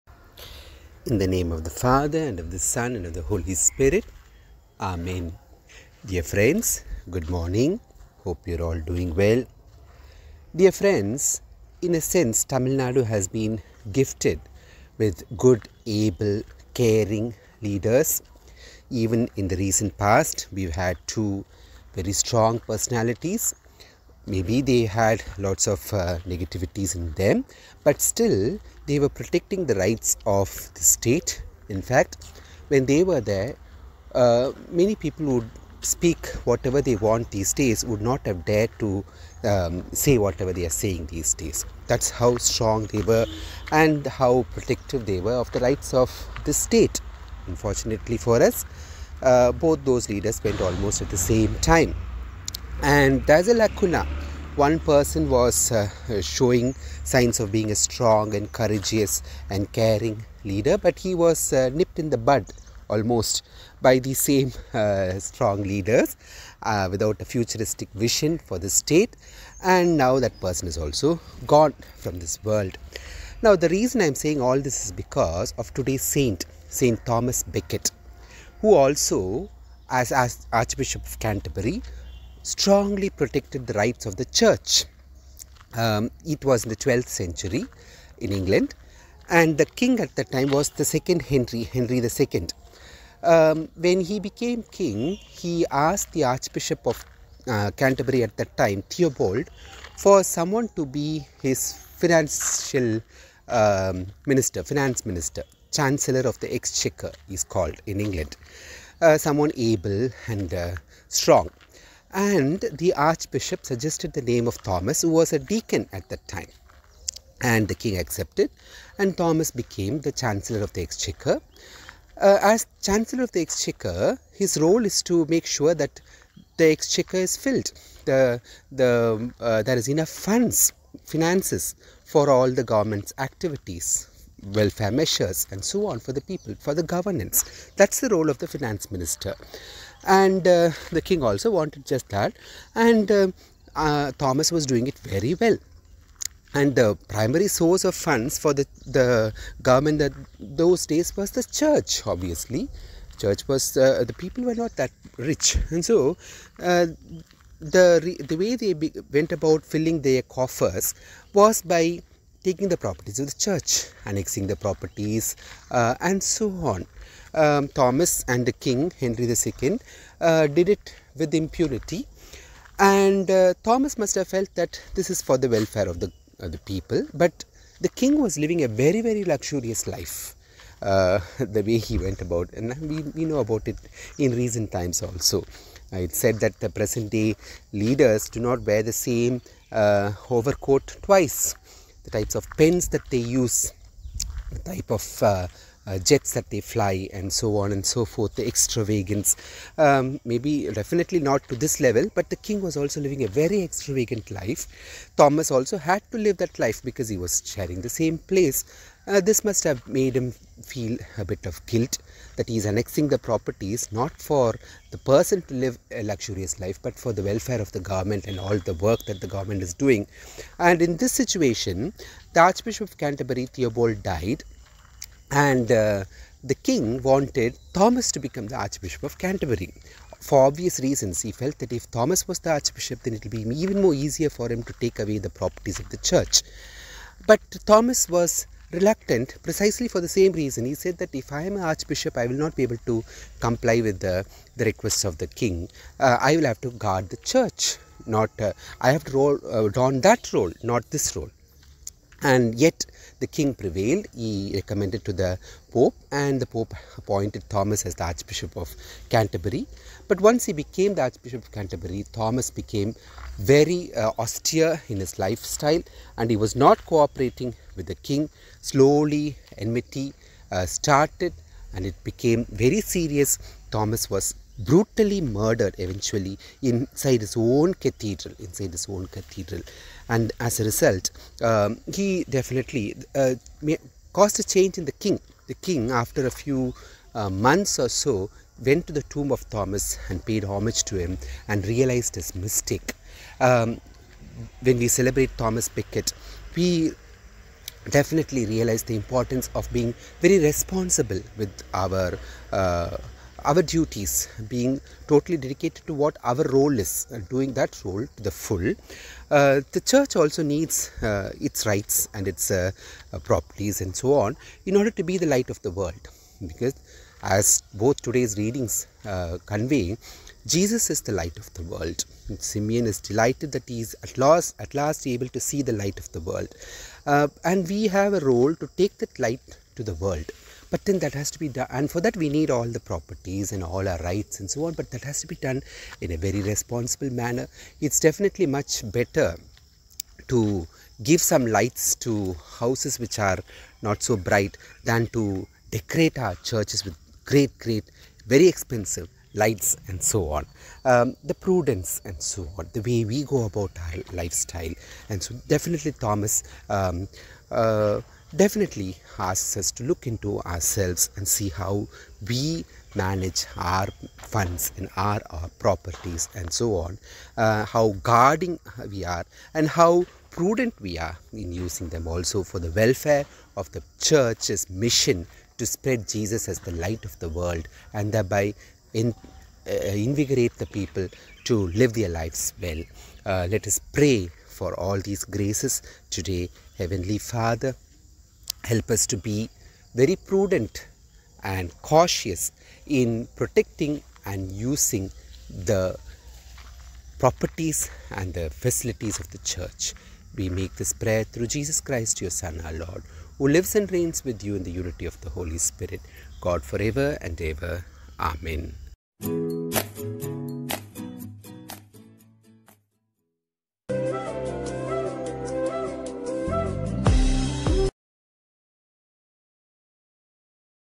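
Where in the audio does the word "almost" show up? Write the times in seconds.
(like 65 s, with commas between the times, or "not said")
50 s, 62 s.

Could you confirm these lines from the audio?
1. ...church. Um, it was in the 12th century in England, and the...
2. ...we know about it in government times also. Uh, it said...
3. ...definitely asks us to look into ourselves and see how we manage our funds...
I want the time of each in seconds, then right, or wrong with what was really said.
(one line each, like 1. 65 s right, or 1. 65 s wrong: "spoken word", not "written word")
1. 84 s right
2. 183 s wrong: "recent", not "government"
3. 358 s right.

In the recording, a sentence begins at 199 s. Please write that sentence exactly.
Um, maybe definitely not to this level, but the king was also living a very extravagant life.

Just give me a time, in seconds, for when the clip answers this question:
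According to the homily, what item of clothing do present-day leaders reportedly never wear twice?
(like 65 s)
190 s.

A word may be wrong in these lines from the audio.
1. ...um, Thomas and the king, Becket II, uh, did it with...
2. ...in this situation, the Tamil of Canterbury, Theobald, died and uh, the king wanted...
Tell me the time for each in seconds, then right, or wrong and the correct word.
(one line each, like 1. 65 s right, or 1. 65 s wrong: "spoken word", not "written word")
1. 167 s wrong: "Henry", not "Becket"
2. 220 s wrong: "Archbishop", not "Tamil".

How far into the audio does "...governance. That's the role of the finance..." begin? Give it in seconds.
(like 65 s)
136 s.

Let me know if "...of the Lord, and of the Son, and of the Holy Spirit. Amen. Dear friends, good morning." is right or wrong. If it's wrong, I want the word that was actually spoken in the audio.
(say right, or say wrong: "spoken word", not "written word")
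wrong: "Father", not "Lord".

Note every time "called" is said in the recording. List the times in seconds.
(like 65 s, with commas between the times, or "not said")
107 s.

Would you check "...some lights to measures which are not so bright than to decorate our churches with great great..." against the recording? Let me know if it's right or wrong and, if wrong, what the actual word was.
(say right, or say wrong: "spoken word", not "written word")
wrong: "houses", not "measures".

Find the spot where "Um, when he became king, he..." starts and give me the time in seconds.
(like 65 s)
93 s.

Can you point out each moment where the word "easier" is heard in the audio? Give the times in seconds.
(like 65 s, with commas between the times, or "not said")
233 s.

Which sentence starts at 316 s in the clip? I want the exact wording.
Because as both today's readings uh, convey, Jesus is the light of the world.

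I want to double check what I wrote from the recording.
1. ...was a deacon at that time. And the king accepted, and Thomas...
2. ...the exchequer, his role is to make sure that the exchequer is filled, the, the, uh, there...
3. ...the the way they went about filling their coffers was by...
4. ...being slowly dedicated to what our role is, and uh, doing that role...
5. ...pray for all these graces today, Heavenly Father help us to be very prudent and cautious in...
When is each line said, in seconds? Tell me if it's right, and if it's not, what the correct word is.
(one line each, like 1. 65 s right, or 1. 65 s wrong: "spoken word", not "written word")
1. 115 s right
2. 123 s right
3. 157 s right
4. 304 s wrong: "totally", not "slowly"
5. 383 s right.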